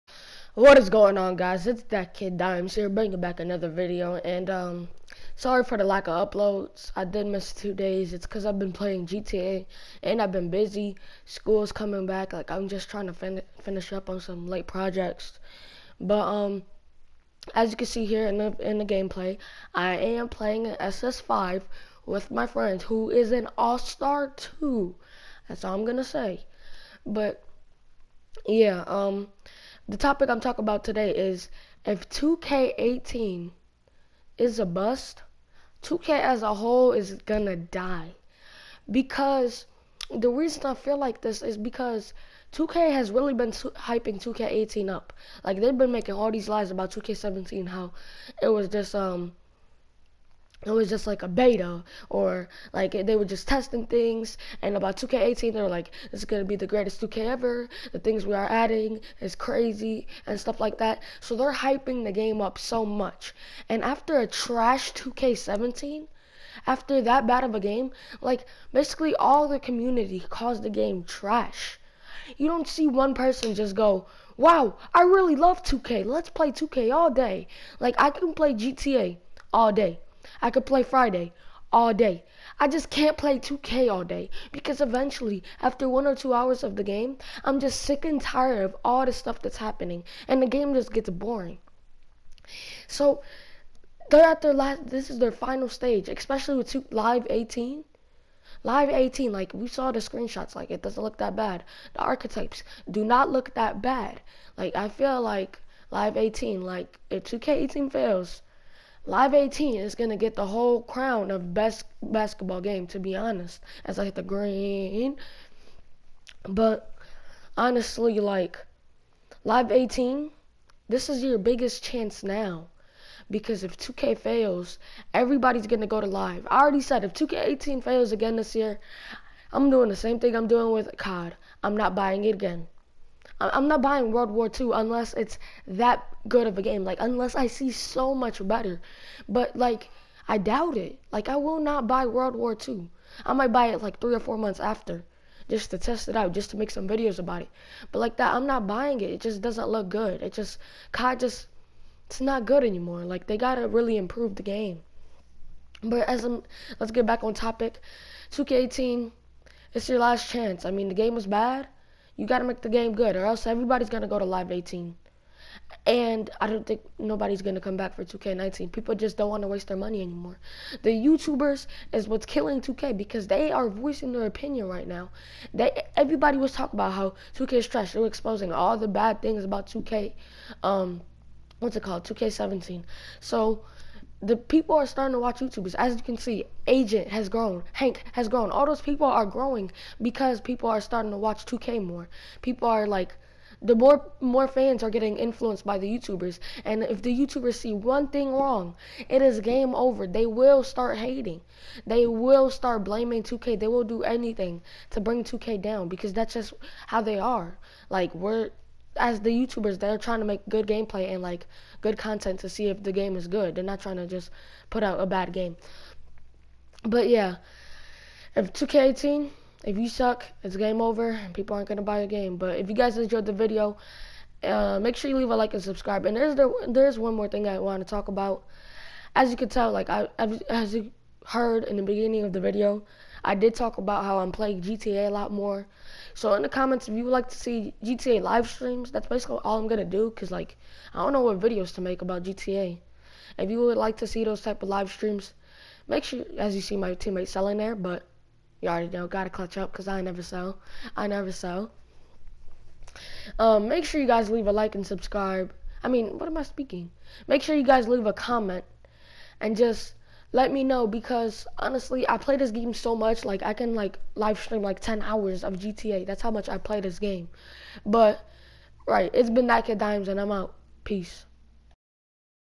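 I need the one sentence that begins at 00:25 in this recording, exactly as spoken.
That's all I'm going to say.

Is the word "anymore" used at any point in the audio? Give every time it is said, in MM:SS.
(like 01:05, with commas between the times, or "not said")
02:32, 02:50.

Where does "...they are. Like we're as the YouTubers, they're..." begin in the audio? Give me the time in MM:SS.
03:27.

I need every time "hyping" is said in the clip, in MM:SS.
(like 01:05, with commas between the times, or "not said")
00:43, 01:01.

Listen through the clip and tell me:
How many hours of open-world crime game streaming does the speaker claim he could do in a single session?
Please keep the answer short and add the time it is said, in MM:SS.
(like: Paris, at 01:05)
10, at 04:24.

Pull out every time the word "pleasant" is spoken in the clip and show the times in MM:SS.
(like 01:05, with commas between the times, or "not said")
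not said.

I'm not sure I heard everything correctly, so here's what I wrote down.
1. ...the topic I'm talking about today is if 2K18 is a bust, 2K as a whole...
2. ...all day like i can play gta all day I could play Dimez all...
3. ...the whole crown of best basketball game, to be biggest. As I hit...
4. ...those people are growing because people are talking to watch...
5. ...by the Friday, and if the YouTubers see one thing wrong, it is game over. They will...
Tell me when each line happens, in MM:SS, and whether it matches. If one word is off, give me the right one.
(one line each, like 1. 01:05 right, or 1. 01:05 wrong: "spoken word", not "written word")
1. 00:29 right
2. 01:16 wrong: "Friday", not "Dimez"
3. 01:50 wrong: "honest", not "biggest"
4. 03:08 wrong: "starting", not "talking"
5. 03:15 wrong: "YouTubers", not "Friday".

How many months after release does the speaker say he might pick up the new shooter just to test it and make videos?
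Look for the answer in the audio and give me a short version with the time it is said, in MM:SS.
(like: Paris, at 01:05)
3 or 4, at 02:23.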